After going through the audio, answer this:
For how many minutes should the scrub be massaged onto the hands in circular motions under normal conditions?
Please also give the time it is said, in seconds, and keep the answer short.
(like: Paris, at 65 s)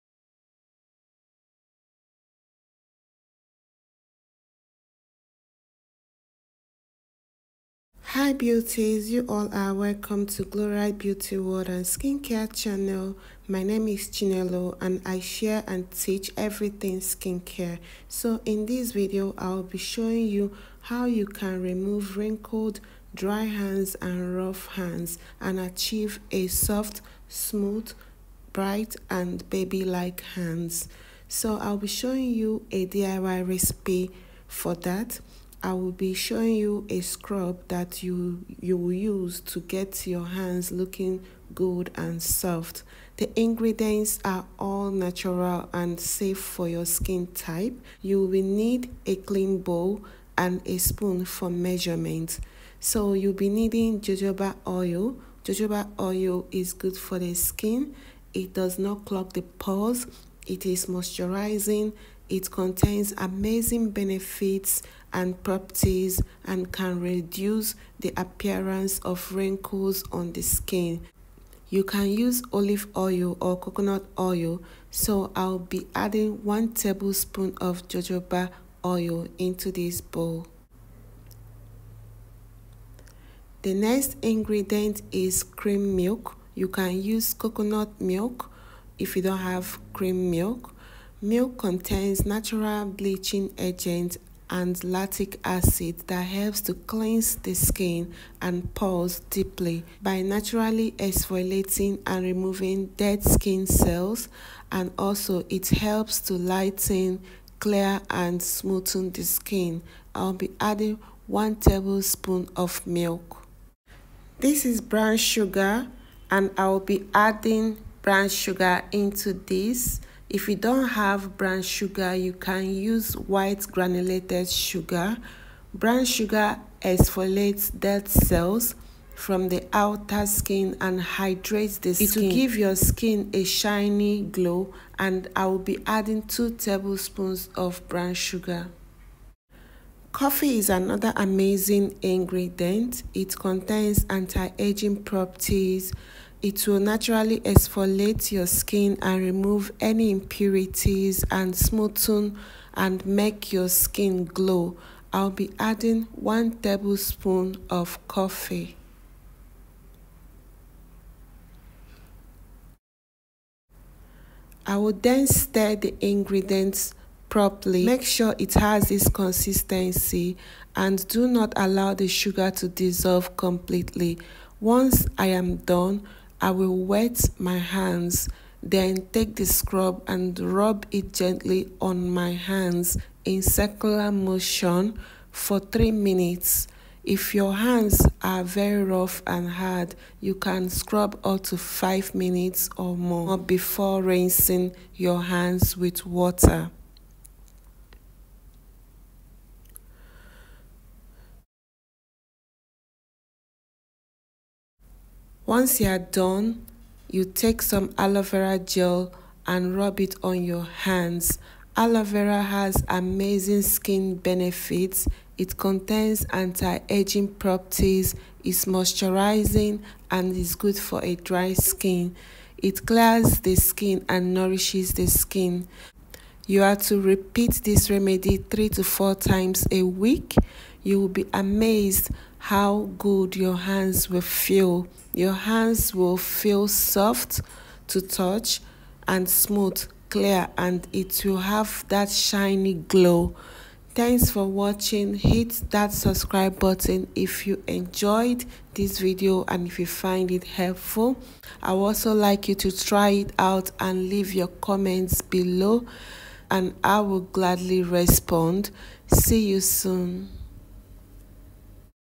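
3, at 185 s.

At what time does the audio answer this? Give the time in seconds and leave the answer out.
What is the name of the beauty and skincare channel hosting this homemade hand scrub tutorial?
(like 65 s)
10 s.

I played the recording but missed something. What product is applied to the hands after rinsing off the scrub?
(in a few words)
aloe vera gel.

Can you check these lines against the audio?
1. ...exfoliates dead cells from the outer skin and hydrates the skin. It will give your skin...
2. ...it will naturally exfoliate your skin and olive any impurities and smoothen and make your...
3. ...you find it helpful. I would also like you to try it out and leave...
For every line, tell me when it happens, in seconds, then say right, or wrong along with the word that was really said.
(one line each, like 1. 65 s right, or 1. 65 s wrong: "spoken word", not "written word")
1. 126 s right
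2. 146 s wrong: "remove", not "olive"
3. 249 s right.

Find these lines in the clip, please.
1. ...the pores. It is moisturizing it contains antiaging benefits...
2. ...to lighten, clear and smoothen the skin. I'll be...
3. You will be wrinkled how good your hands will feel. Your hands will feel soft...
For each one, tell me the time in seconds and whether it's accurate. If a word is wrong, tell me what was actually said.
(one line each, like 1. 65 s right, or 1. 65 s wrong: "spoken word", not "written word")
1. 59 s wrong: "amazing", not "antiaging"
2. 106 s right
3. 230 s wrong: "amazed", not "wrinkled".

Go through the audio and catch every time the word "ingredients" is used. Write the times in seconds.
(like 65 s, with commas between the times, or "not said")
43 s, 84 s, 142 s, 166 s.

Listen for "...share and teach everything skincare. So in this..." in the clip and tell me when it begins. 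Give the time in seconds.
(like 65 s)
15 s.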